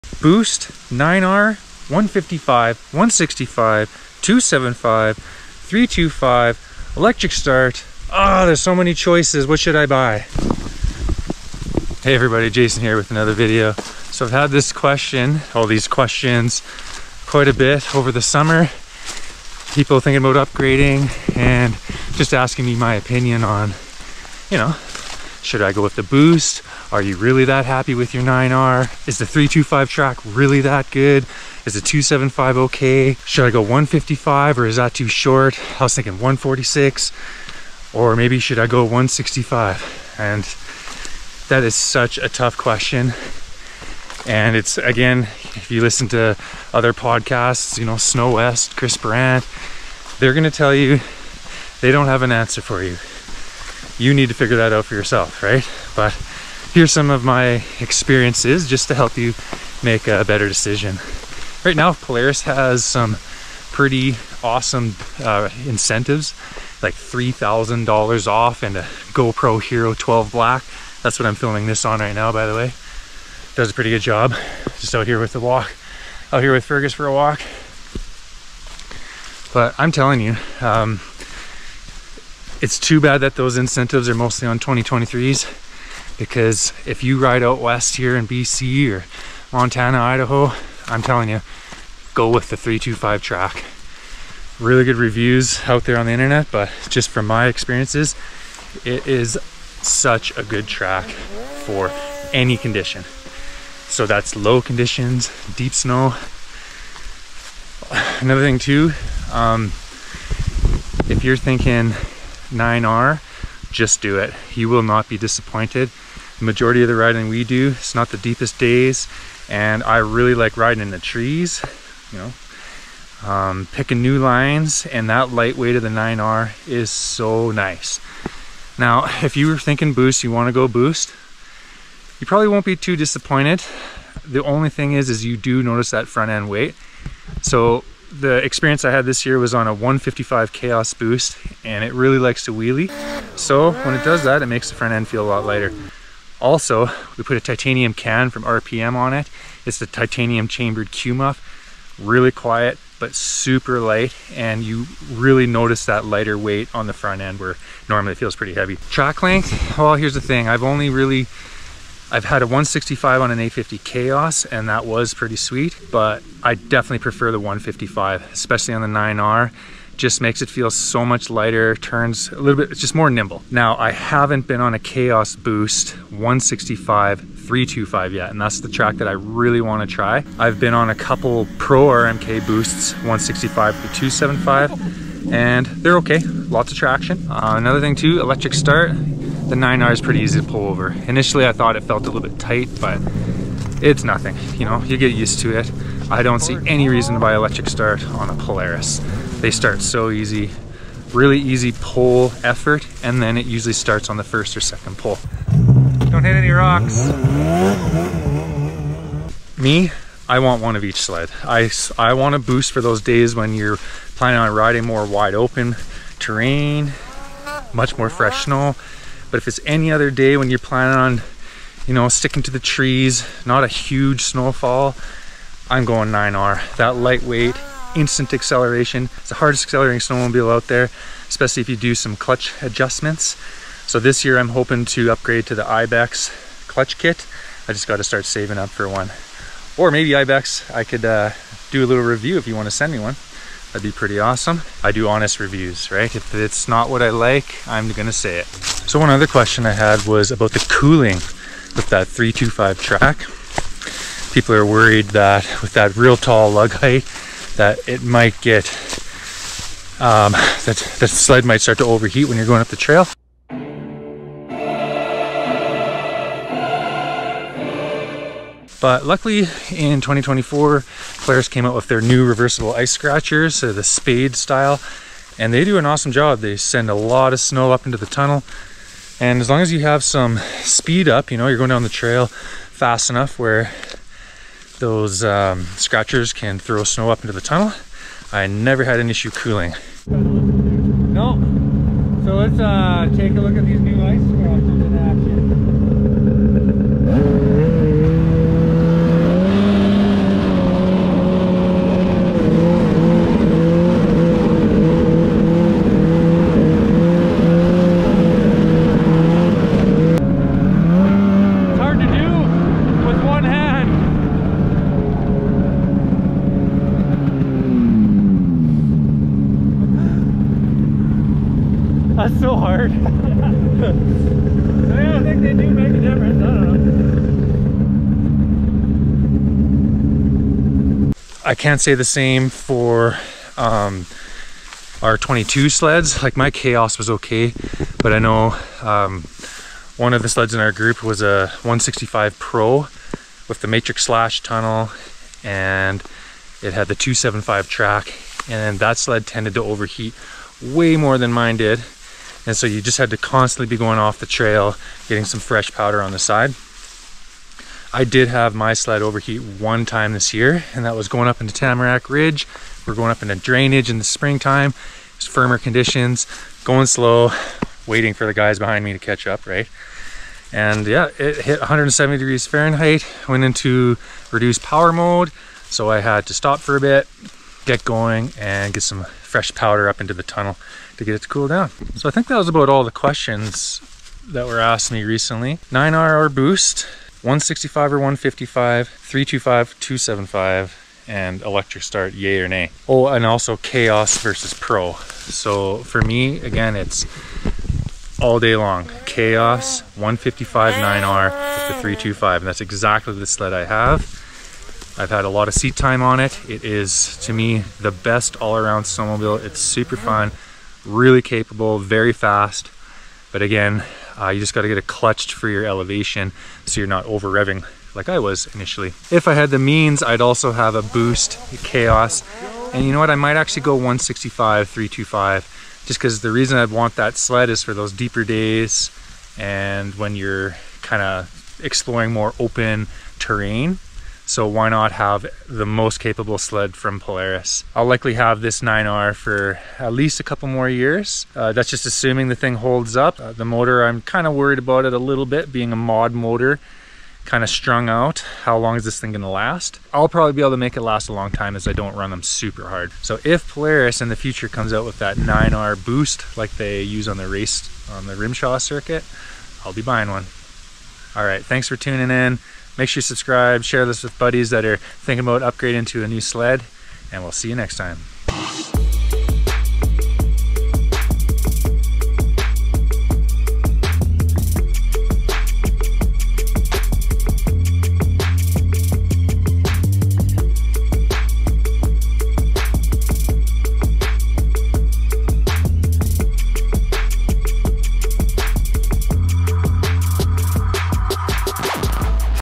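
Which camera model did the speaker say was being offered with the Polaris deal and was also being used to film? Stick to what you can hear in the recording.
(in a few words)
GoPro Hero 12 Black.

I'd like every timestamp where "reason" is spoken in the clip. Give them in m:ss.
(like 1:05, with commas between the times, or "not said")
3:16, 7:06.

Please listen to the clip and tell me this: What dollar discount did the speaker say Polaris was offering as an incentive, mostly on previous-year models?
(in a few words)
$3,000.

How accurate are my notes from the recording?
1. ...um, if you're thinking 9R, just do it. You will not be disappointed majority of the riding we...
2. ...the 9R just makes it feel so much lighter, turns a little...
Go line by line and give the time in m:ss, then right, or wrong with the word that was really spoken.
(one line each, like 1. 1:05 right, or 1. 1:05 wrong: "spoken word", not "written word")
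1. 1:49 right
2. 2:48 right.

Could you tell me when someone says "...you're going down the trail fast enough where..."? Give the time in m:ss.
4:41.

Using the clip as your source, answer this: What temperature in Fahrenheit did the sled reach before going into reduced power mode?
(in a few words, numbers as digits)
170.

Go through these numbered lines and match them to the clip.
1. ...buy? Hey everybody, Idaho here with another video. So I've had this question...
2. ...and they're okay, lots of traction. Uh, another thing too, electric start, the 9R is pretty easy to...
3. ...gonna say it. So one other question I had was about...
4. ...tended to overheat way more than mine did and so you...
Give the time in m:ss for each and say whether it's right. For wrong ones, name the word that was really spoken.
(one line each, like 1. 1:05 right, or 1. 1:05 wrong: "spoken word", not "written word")
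1. 0:09 wrong: "Jason", not "Idaho"
2. 3:05 right
3. 4:07 right
4. 5:49 right.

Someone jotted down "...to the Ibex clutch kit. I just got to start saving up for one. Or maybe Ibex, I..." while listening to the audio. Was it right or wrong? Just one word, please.
right.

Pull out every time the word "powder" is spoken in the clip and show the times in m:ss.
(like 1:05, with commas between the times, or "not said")
5:55, 6:19.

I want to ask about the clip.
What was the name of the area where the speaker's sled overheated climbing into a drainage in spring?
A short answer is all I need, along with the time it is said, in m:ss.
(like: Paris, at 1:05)
Tamarack Ridge, at 6:01.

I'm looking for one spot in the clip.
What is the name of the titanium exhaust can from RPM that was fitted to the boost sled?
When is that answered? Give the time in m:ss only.
2:30.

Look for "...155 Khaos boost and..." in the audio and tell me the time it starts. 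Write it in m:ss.
2:19.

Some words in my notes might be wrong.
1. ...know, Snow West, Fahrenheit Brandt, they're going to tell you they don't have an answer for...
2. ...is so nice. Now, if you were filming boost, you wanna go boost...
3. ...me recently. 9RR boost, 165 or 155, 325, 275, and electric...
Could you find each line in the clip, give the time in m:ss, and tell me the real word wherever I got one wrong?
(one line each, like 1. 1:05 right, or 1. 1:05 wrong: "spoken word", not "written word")
1. 0:47 wrong: "Chris", not "Fahrenheit"
2. 2:06 wrong: "thinking", not "filming"
3. 6:24 right.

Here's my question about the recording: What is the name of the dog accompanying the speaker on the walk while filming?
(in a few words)
Fergus.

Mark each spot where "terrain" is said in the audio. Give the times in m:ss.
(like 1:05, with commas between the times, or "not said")
3:36, 7:13.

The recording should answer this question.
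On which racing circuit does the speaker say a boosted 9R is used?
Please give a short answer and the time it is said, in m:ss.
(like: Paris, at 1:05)
RMSHA, at 7:38.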